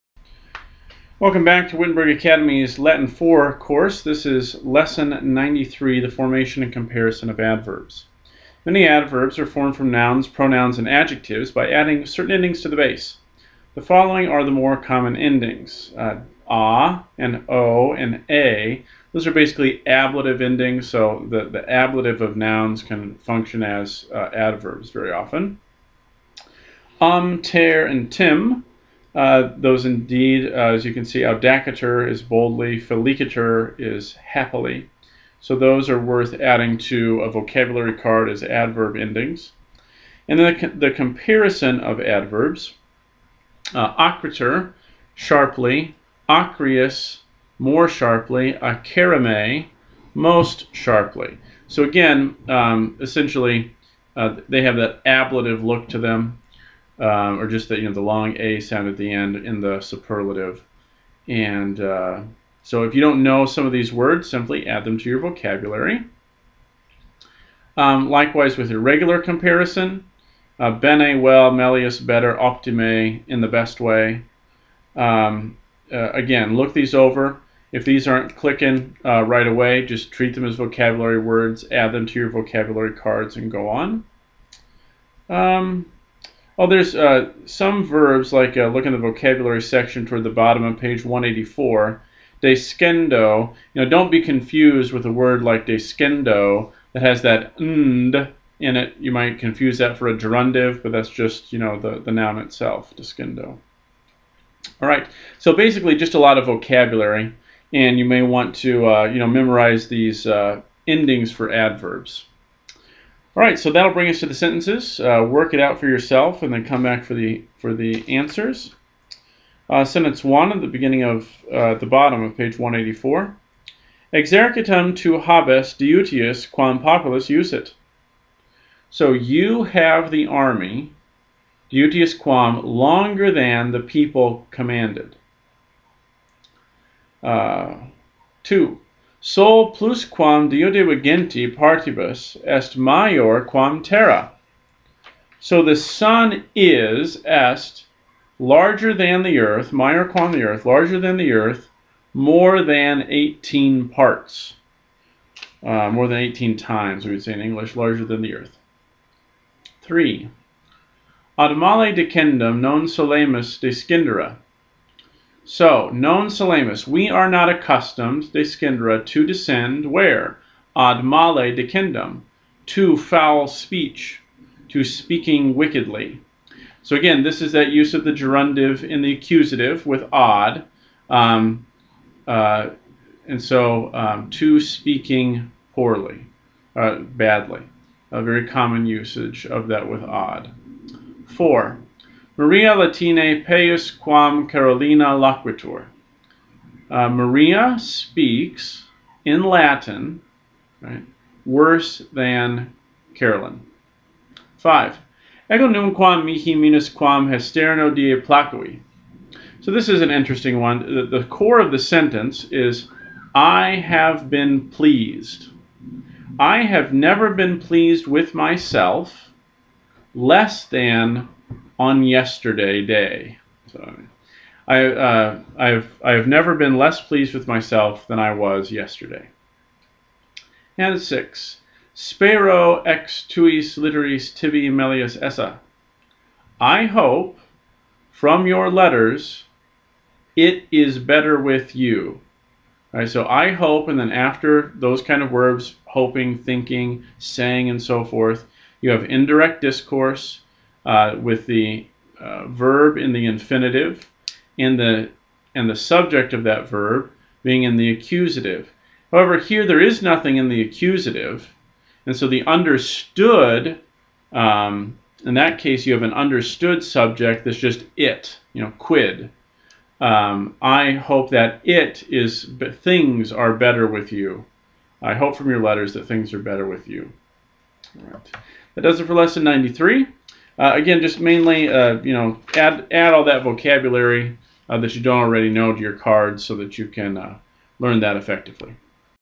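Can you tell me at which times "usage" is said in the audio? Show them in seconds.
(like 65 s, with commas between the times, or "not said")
188 s.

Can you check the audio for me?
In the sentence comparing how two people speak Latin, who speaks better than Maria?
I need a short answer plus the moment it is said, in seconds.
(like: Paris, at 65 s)
Carolina, at 194 s.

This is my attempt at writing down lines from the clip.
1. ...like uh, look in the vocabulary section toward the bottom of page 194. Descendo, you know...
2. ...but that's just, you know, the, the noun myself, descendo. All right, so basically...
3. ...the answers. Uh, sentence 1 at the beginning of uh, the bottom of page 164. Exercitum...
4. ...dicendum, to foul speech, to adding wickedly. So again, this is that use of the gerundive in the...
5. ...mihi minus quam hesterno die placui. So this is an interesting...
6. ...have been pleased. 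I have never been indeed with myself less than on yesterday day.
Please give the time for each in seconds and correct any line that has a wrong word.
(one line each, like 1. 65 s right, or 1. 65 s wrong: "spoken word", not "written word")
1. 88 s wrong: "184", not "194"
2. 100 s wrong: "itself", not "myself"
3. 117 s wrong: "184", not "164"
4. 171 s wrong: "speaking", not "adding"
5. 206 s right
6. 213 s wrong: "pleased", not "indeed".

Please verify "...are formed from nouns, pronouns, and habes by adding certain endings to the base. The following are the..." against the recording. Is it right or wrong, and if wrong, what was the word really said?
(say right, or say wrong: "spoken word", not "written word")
wrong: "adjectives", not "habes".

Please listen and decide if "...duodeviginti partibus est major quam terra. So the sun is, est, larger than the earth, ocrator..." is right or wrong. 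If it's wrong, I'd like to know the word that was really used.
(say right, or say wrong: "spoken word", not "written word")
wrong: "minor", not "ocrator".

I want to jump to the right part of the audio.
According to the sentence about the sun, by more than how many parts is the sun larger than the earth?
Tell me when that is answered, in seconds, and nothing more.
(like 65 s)
153 s.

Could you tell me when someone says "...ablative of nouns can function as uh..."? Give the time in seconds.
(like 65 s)
21 s.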